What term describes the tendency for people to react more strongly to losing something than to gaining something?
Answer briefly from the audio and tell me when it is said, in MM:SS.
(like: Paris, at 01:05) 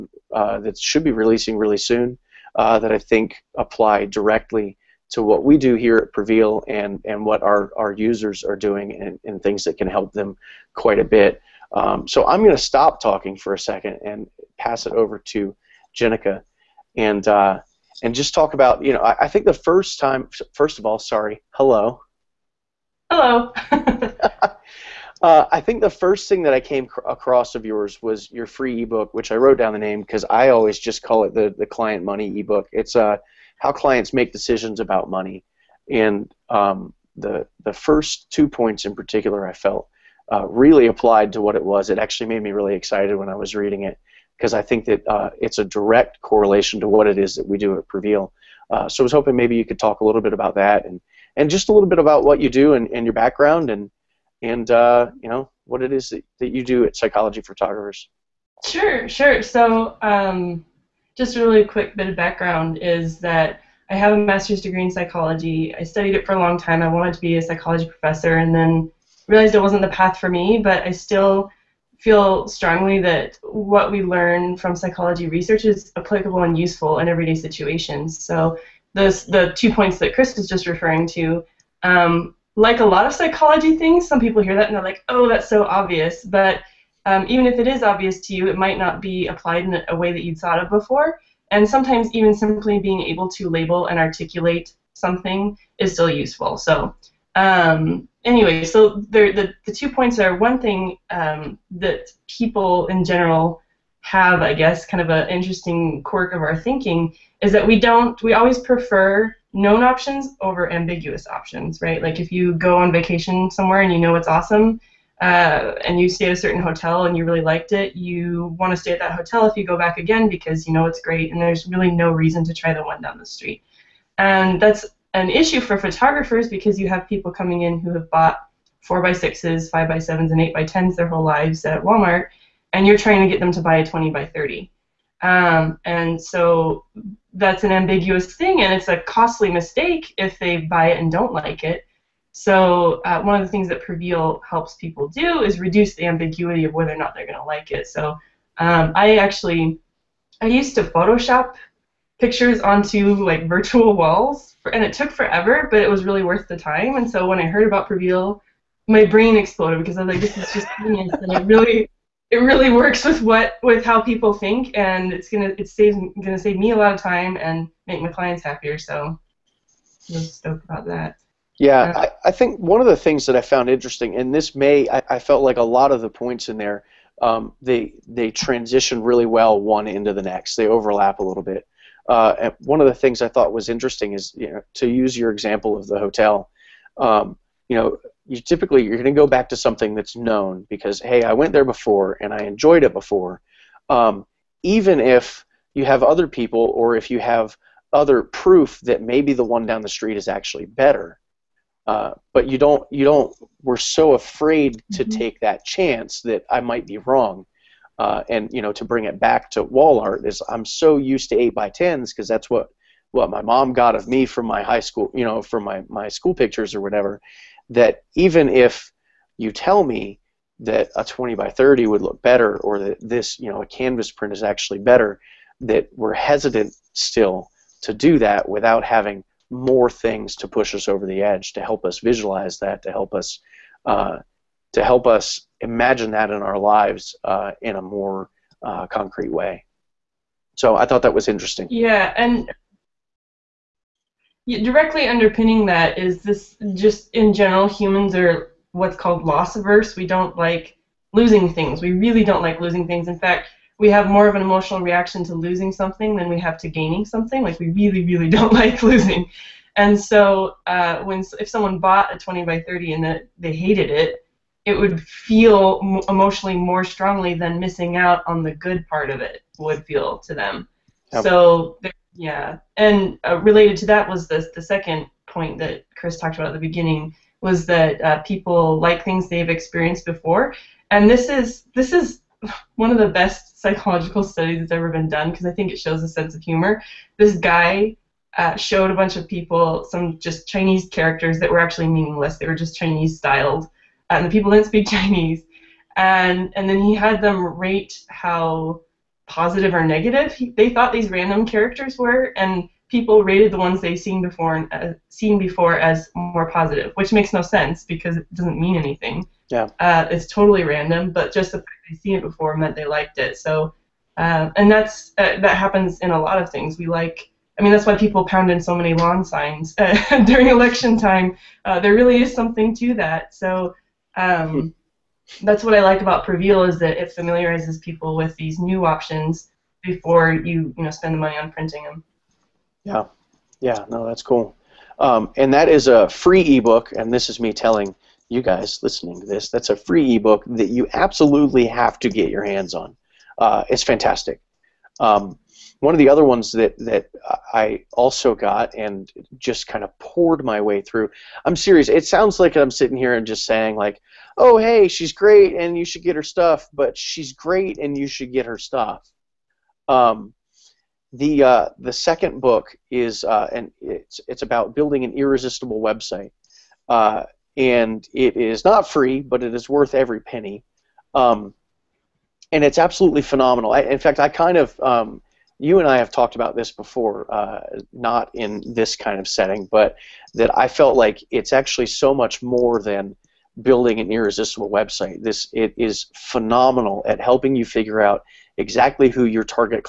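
Loss averse, at 04:09.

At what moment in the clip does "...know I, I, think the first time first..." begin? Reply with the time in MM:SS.
00:18.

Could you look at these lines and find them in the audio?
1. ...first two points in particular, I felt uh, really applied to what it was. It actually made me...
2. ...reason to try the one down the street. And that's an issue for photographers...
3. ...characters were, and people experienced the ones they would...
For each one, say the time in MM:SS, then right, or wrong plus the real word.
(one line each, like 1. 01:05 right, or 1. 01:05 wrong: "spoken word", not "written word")
1. 00:37 right
2. 02:02 right
3. 05:01 wrong: "rated", not "experienced".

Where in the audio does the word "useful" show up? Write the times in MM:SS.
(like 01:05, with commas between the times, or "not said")
01:16, 01:36.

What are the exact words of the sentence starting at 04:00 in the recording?
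So I thought that was interesting.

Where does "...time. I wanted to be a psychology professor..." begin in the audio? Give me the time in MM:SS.
01:06.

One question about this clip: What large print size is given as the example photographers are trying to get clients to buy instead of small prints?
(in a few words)
20x30.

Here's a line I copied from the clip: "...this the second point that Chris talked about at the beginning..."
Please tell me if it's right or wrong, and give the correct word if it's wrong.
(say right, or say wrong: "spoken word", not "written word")
right.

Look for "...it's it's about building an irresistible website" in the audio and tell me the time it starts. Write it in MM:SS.
06:03.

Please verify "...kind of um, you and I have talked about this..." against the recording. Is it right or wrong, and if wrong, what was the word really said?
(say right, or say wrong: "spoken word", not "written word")
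right.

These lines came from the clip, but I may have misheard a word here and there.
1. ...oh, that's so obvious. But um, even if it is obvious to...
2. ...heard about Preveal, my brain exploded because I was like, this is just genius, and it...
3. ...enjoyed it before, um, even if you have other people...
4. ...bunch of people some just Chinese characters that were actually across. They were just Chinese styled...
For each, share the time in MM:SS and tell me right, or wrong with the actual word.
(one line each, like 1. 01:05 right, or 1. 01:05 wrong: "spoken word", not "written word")
1. 01:25 right
2. 02:37 right
3. 03:12 right
4. 04:48 wrong: "meaningless", not "across".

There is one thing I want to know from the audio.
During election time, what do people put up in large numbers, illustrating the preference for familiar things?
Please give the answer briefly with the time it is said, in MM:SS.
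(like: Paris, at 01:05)
Lawn signs, at 05:18.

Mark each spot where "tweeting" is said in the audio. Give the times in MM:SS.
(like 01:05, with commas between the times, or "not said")
not said.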